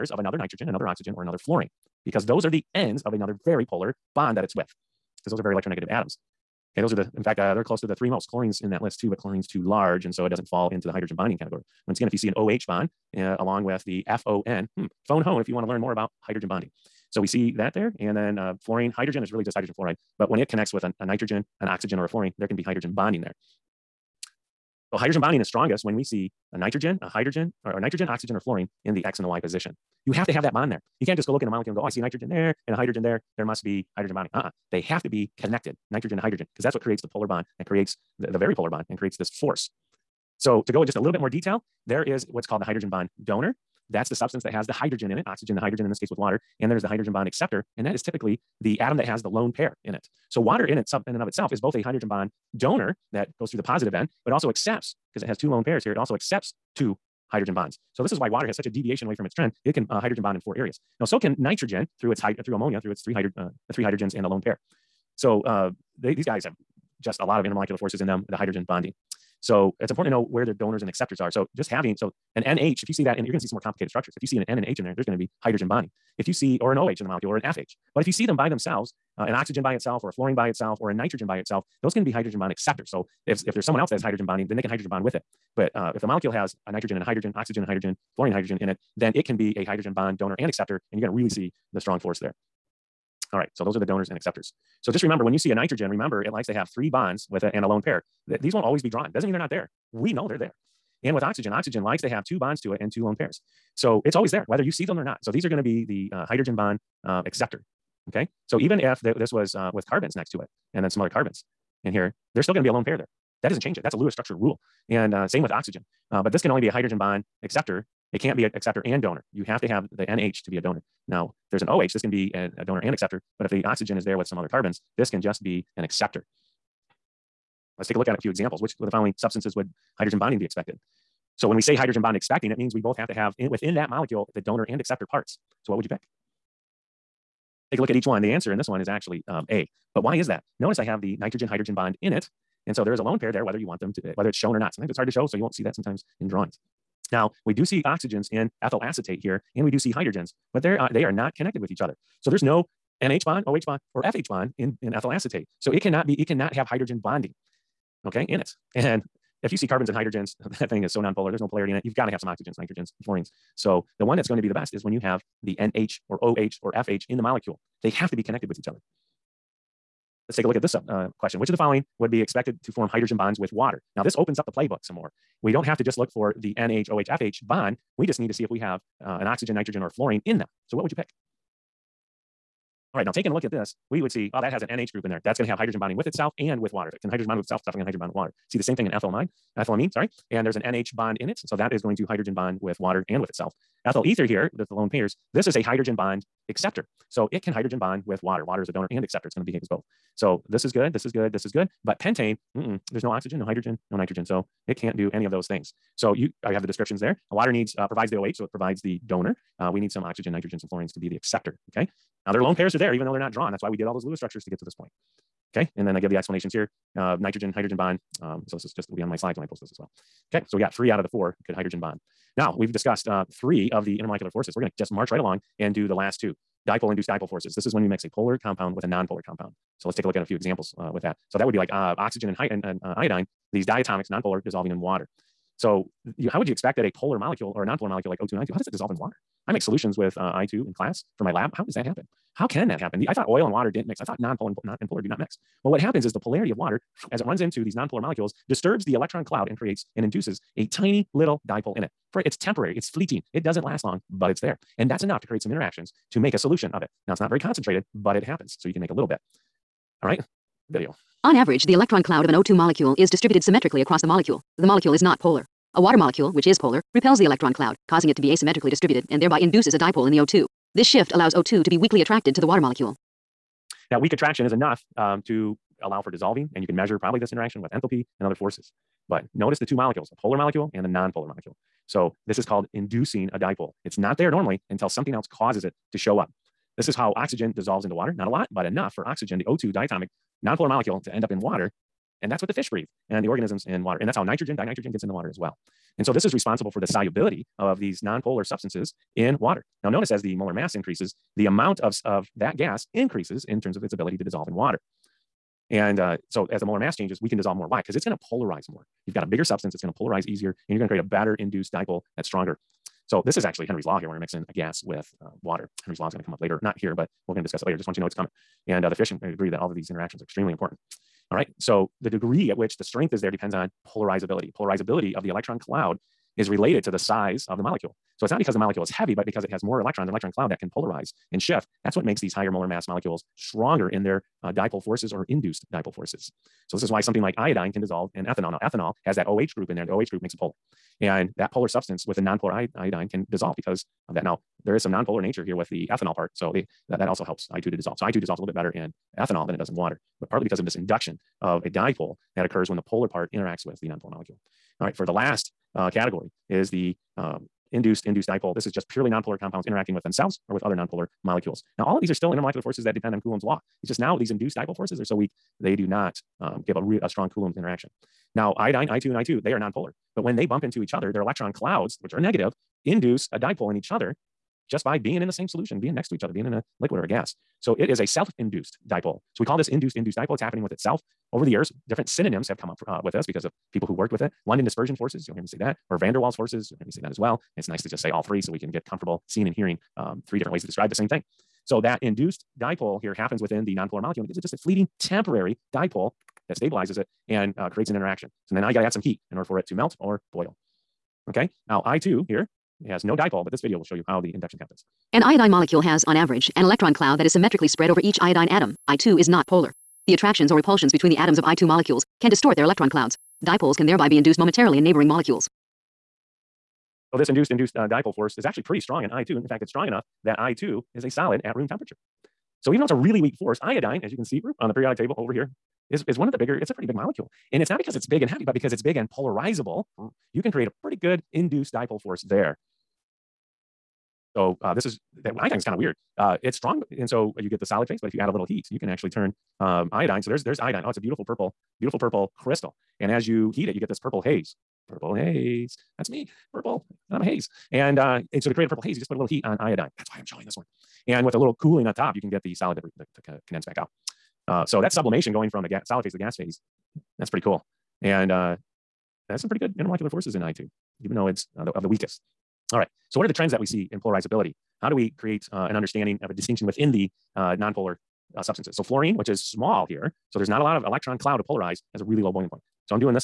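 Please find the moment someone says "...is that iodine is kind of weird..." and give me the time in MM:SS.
07:14.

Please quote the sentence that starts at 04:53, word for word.
And that's how nitrogen, dinitrogen gets in the water as well.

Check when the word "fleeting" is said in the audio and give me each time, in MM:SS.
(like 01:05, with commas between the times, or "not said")
04:12, 06:34.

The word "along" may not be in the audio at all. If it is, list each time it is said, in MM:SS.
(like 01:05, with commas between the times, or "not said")
00:13, 03:45.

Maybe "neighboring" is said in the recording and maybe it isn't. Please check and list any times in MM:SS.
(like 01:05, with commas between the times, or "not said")
06:54.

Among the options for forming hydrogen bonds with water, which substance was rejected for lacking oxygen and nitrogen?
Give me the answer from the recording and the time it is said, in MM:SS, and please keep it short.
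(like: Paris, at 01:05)
pentane, at 03:21.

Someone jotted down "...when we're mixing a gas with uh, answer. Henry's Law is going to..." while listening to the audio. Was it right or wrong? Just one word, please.
wrong.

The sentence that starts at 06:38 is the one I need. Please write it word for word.
So then now you got to add some heat in order for it to melt or boil.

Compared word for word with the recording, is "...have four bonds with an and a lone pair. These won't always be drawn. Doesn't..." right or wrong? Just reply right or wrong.
wrong.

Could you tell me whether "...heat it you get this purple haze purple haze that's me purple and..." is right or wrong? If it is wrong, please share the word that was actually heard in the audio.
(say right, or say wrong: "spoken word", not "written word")
right.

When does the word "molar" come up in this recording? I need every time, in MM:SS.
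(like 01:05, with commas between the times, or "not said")
05:00, 05:06, 05:32.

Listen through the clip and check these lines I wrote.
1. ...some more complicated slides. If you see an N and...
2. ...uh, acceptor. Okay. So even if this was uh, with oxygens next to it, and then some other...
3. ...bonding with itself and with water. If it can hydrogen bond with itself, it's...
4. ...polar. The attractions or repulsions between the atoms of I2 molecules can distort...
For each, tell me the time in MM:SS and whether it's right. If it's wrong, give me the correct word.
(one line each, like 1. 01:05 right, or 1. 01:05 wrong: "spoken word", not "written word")
1. 01:13 wrong: "structures", not "slides"
2. 01:47 wrong: "carbons", not "oxygens"
3. 03:05 right
4. 06:49 right.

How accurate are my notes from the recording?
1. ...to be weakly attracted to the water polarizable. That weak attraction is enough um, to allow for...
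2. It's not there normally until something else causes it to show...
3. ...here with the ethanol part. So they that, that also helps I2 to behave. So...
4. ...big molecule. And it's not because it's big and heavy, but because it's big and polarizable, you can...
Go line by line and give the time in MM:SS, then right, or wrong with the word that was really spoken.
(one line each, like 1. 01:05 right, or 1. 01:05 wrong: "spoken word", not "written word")
1. 04:31 wrong: "molecule", not "polarizable"
2. 04:43 right
3. 05:45 wrong: "dissolve", not "behave"
4. 07:06 right.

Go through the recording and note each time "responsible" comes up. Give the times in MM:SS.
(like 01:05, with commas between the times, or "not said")
04:56.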